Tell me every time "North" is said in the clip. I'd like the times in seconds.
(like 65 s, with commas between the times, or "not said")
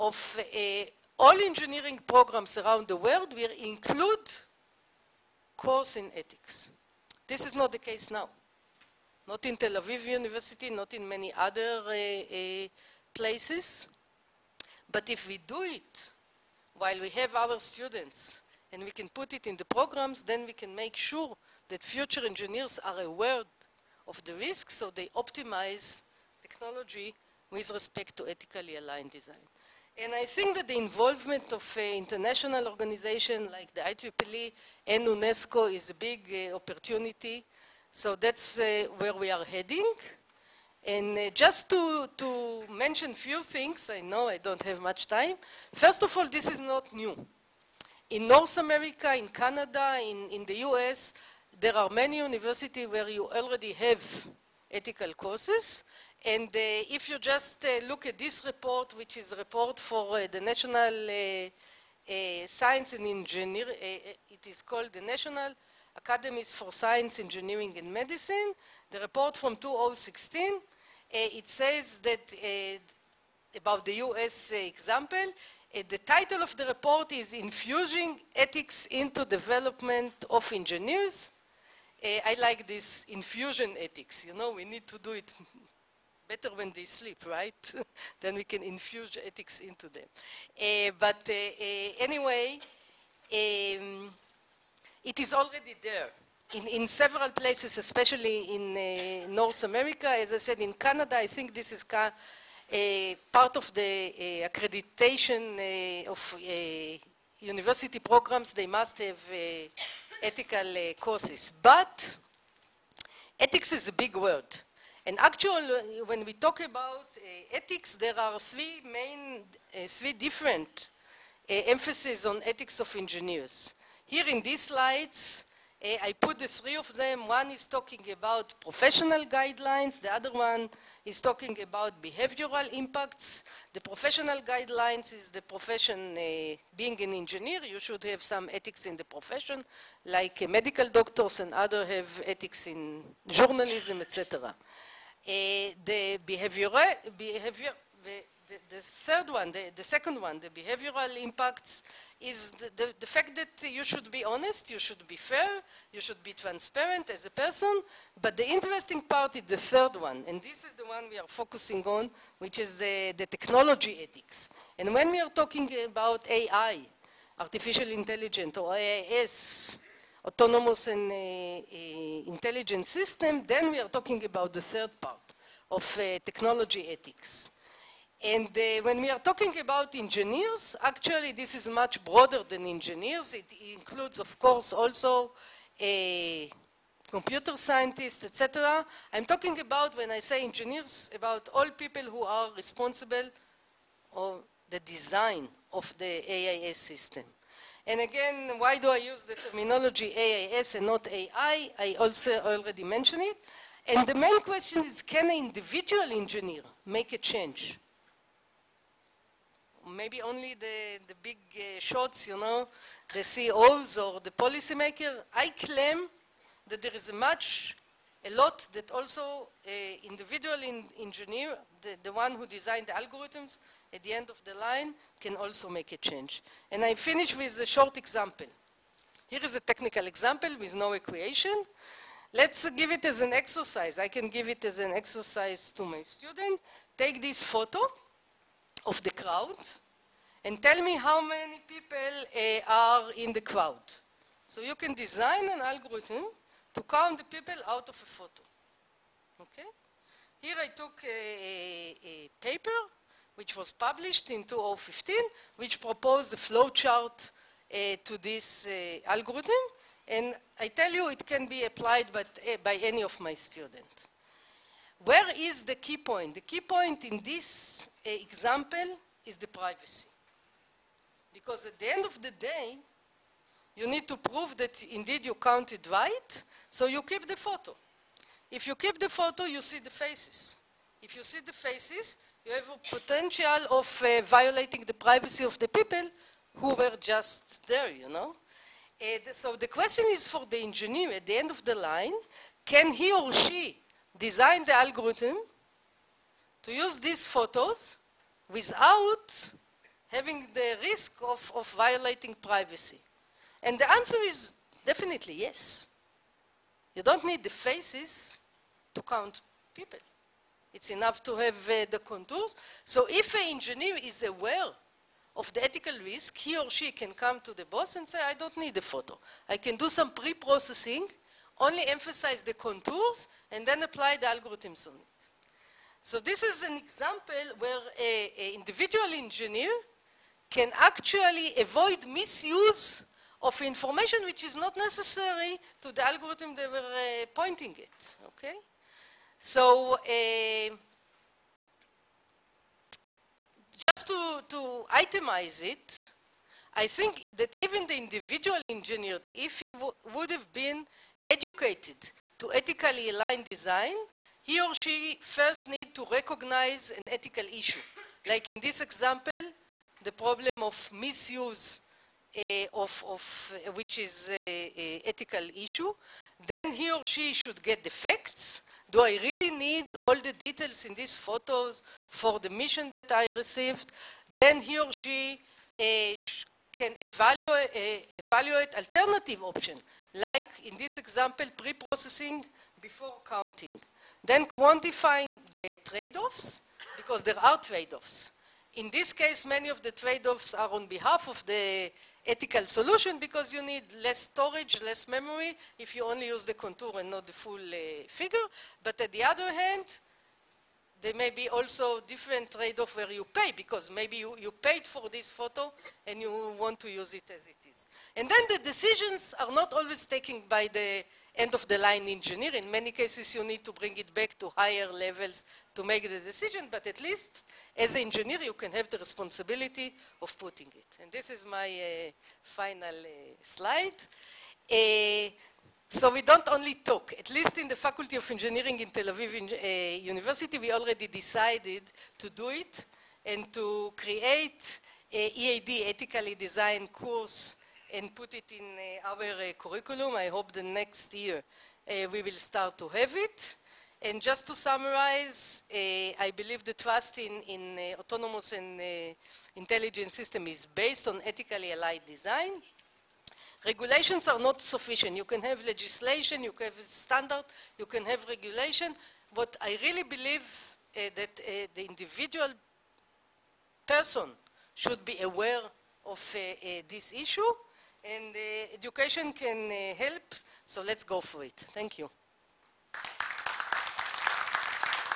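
48 s, 99 s.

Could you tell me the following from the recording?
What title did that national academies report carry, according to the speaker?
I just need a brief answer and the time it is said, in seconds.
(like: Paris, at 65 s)
Infusing Ethics into Development of Engineers, at 77 s.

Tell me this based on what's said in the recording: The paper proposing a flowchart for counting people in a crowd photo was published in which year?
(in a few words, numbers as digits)
2015.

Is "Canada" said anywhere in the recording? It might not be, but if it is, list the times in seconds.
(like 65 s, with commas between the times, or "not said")
49 s, 100 s.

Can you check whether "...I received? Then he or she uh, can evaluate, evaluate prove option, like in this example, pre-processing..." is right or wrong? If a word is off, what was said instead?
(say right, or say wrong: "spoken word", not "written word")
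wrong: "alternative", not "prove".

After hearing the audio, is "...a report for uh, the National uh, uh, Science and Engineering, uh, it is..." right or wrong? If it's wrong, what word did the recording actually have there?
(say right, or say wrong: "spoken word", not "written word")
right.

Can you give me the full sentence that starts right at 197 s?
And again, why do I use the terminology AIS and not AI?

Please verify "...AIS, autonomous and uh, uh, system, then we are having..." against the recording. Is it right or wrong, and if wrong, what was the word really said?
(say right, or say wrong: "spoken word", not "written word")
wrong: "talking", not "having".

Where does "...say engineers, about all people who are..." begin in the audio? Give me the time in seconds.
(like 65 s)
190 s.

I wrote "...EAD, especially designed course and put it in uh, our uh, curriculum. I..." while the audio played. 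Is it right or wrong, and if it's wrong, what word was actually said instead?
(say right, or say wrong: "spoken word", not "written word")
wrong: "ethically", not "especially".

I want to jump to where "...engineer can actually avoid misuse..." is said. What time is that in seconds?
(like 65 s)
329 s.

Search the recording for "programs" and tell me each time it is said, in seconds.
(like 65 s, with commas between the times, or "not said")
2 s, 19 s, 107 s.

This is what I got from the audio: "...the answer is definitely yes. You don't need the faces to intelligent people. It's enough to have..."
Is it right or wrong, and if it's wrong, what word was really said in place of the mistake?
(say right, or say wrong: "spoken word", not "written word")
wrong: "count", not "intelligent".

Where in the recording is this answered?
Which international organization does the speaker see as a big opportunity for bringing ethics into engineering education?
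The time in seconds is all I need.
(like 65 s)
35 s.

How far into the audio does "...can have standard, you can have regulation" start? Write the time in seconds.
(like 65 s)
456 s.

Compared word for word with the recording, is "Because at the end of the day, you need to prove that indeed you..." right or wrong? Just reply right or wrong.
right.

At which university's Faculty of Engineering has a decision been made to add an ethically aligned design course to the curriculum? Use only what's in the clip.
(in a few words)
Tel Aviv University.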